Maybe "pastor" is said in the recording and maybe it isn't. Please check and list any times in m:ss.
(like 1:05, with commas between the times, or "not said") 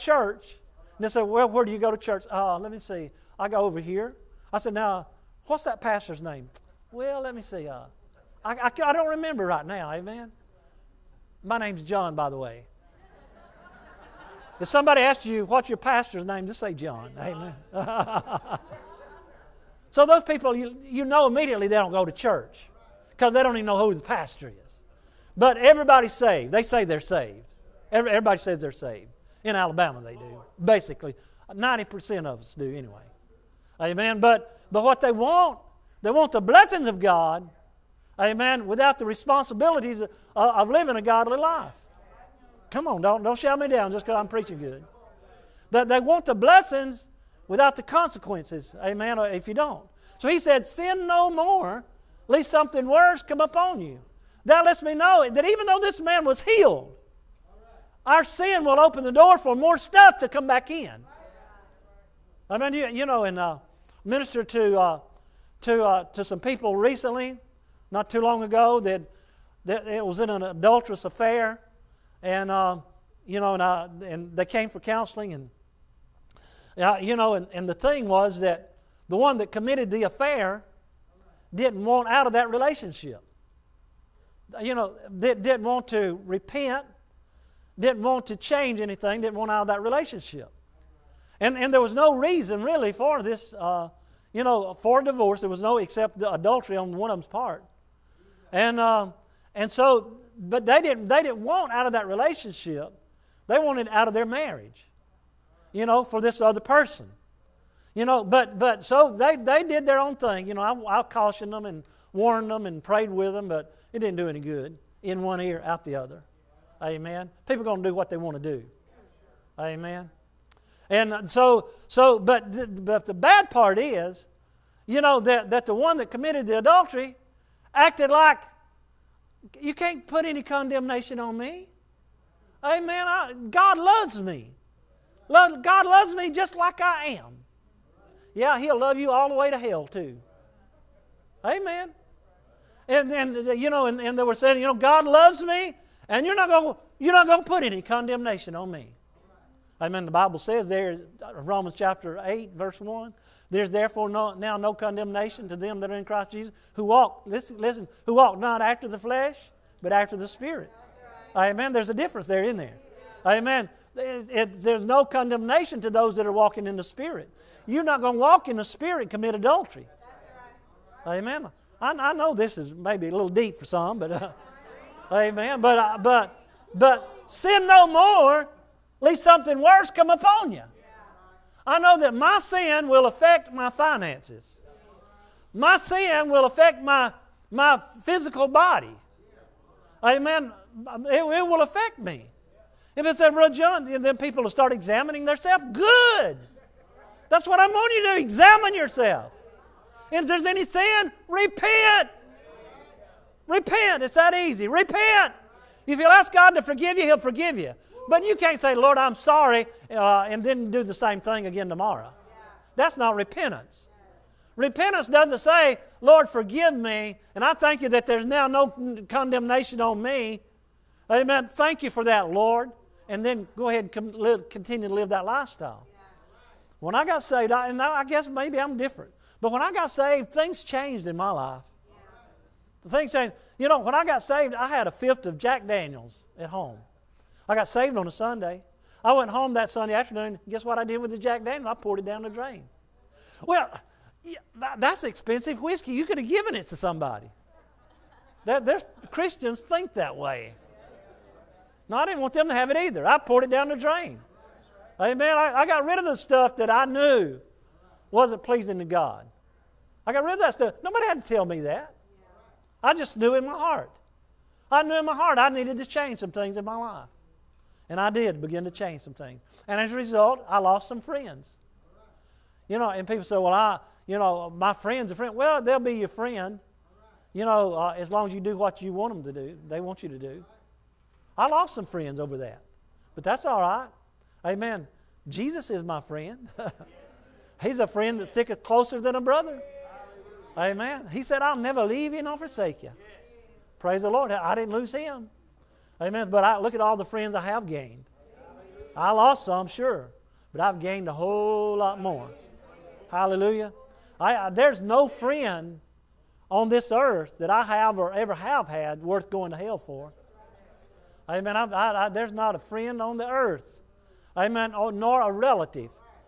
0:05, 0:15, 0:24.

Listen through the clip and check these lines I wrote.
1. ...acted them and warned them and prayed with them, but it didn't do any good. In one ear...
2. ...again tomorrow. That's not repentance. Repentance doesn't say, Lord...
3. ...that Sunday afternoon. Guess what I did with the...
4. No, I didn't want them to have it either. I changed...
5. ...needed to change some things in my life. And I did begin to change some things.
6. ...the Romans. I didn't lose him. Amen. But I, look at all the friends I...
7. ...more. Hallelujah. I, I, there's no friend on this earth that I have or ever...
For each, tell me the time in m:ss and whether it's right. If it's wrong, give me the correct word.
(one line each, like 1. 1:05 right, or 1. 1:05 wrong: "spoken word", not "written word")
1. 1:51 wrong: "cautioned", not "acted"
2. 3:31 right
3. 3:59 right
4. 4:11 wrong: "poured", not "changed"
5. 4:25 right
6. 4:54 wrong: "Lord", not "Romans"
7. 5:02 right.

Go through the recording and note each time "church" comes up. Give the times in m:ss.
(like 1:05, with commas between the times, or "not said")
0:01, 0:22.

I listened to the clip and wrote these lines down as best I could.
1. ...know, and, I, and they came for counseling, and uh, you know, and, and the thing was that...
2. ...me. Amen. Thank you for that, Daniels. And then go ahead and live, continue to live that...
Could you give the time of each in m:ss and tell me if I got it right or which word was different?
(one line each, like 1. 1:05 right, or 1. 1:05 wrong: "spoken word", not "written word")
1. 1:13 right
2. 3:40 wrong: "Lord", not "Daniels".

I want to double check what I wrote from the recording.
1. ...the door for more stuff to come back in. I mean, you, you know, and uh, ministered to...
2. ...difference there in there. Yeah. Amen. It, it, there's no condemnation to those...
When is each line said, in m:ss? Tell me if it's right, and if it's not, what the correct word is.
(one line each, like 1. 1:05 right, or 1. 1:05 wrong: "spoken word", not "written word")
1. 0:59 right
2. 2:41 right.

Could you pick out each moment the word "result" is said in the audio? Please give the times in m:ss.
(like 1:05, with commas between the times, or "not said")
4:29.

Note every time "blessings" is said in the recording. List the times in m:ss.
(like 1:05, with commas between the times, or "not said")
0:36, 0:46.